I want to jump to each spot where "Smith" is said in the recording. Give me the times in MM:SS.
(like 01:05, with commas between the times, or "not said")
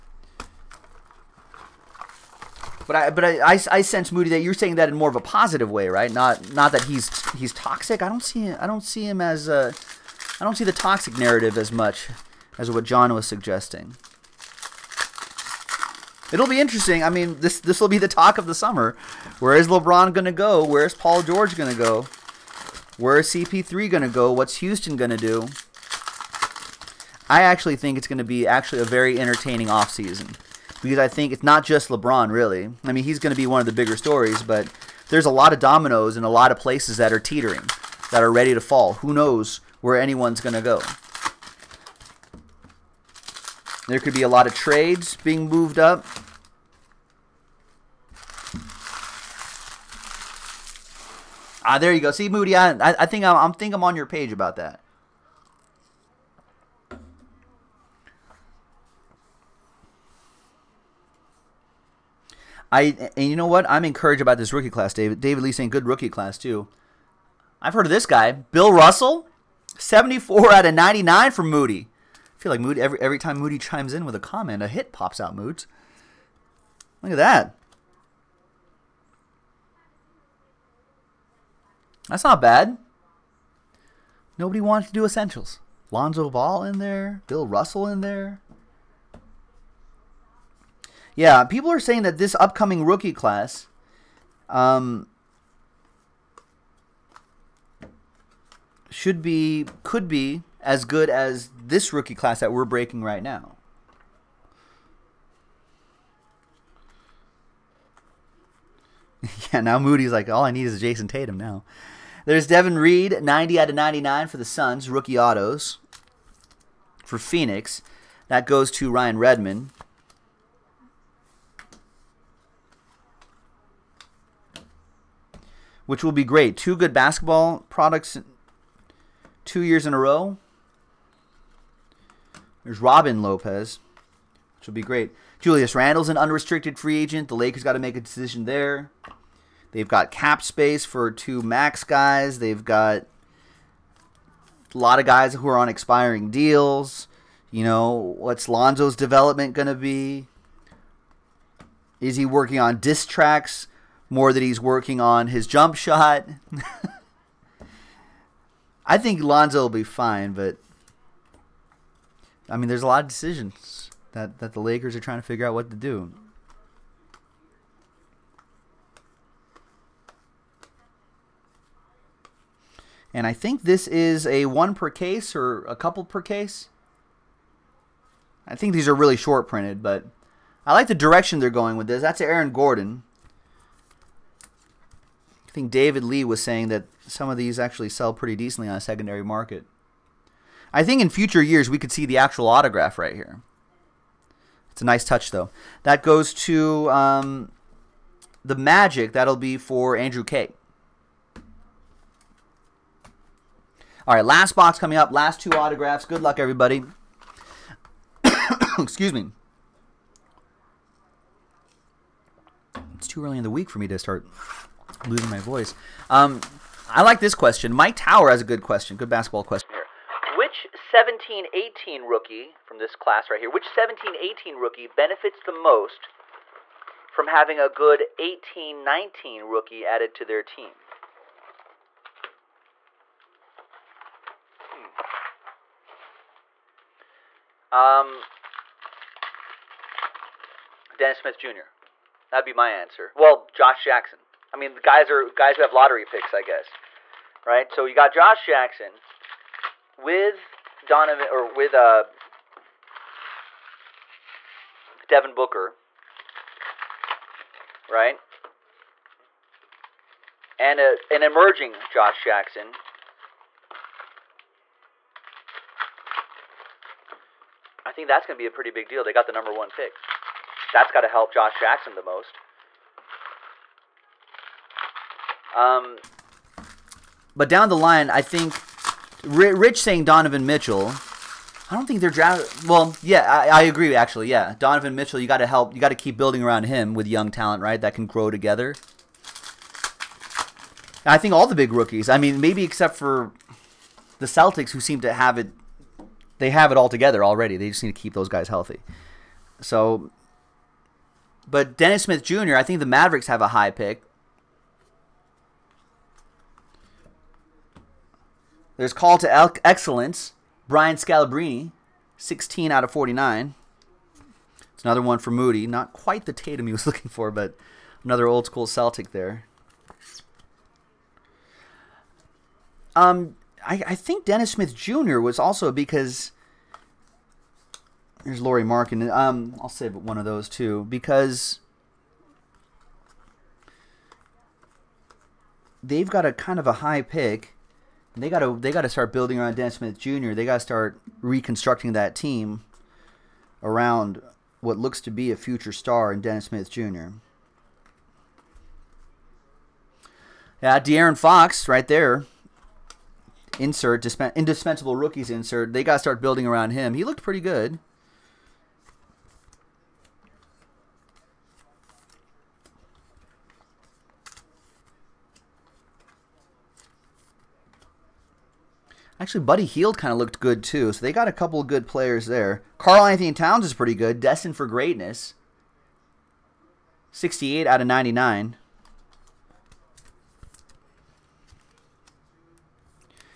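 04:01, 05:02, 05:24, 05:39, 05:46.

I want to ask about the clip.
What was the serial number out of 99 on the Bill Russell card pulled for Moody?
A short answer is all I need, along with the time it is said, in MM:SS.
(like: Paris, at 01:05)
74, at 01:09.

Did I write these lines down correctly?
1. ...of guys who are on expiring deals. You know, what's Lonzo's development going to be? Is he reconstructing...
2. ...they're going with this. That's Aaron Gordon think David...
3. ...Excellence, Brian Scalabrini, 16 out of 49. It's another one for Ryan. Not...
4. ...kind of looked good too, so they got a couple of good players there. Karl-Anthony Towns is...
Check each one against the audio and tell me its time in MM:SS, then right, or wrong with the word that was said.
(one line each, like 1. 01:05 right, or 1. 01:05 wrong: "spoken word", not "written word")
1. 02:24 wrong: "working", not "reconstructing"
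2. 03:01 right
3. 05:09 wrong: "Moody", not "Ryan"
4. 06:09 right.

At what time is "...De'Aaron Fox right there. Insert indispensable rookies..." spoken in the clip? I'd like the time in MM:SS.
05:50.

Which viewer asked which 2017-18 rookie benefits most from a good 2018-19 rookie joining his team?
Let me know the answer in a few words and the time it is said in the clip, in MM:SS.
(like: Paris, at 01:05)
Mike Tower, at 03:37.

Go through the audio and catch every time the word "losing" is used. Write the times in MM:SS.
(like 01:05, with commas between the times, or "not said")
03:35.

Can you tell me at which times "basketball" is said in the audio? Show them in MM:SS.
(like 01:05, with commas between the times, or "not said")
02:06, 03:39.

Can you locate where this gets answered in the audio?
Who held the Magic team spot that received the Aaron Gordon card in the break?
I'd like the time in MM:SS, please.
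03:19.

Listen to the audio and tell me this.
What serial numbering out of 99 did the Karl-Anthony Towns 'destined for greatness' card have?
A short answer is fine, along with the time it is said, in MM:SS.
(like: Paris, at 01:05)
68, at 06:17.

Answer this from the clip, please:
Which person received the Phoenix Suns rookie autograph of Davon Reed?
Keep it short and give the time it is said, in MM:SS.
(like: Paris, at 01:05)
Ryan Redmond, at 01:58.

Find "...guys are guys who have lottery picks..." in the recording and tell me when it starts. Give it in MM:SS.
04:04.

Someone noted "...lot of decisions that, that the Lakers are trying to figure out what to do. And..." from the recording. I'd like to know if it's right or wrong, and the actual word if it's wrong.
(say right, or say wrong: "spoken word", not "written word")
right.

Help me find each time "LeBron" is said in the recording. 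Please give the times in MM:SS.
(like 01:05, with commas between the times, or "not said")
00:19, 00:31.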